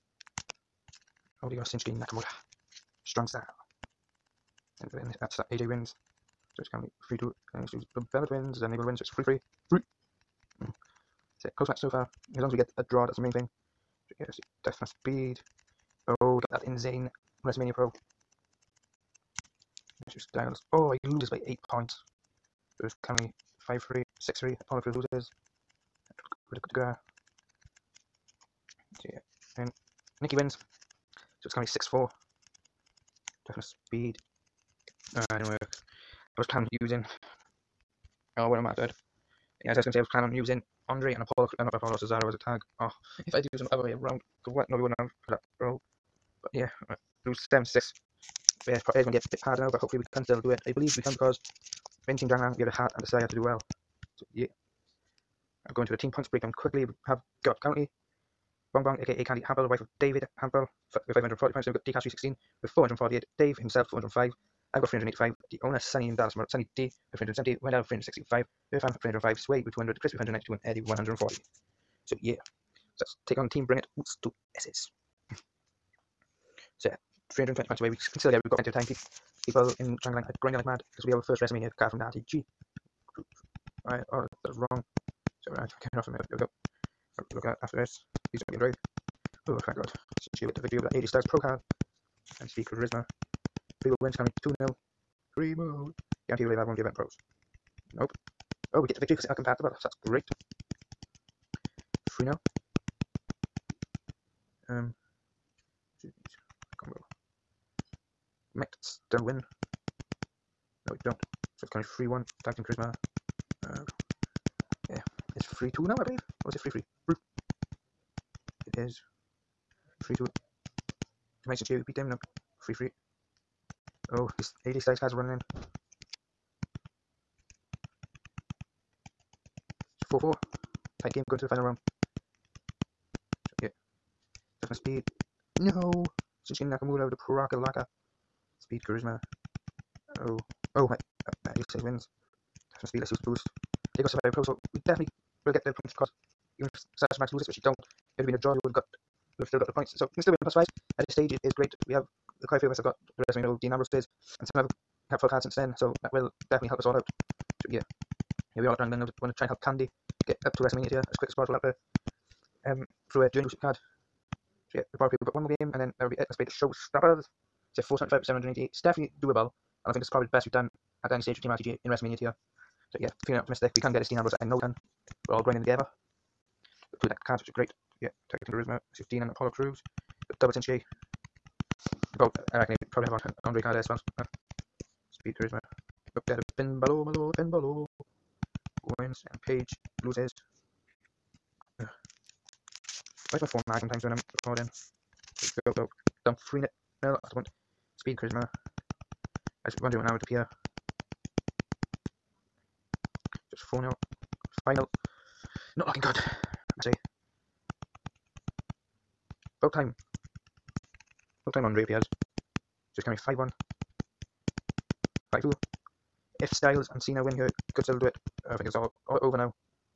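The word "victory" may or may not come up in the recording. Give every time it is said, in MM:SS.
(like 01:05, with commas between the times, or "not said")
01:30, 01:38.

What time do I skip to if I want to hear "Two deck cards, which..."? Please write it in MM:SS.
02:57.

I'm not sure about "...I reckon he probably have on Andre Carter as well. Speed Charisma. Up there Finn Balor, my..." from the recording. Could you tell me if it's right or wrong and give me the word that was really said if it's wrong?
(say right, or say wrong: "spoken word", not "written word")
right.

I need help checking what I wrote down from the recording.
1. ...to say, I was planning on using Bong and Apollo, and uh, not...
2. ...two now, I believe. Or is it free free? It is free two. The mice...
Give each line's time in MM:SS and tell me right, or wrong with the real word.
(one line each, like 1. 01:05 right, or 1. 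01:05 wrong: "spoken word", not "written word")
1. 00:39 wrong: "Andre", not "Bong"
2. 01:55 right.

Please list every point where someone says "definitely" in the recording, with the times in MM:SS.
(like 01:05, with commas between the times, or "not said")
02:24, 02:36, 02:48.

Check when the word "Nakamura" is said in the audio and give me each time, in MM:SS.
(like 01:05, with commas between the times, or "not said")
00:01, 02:16.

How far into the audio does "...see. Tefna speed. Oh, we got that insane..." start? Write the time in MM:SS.
00:14.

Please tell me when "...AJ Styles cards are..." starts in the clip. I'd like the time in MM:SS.
02:04.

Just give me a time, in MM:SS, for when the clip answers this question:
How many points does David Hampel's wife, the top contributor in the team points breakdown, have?
01:01.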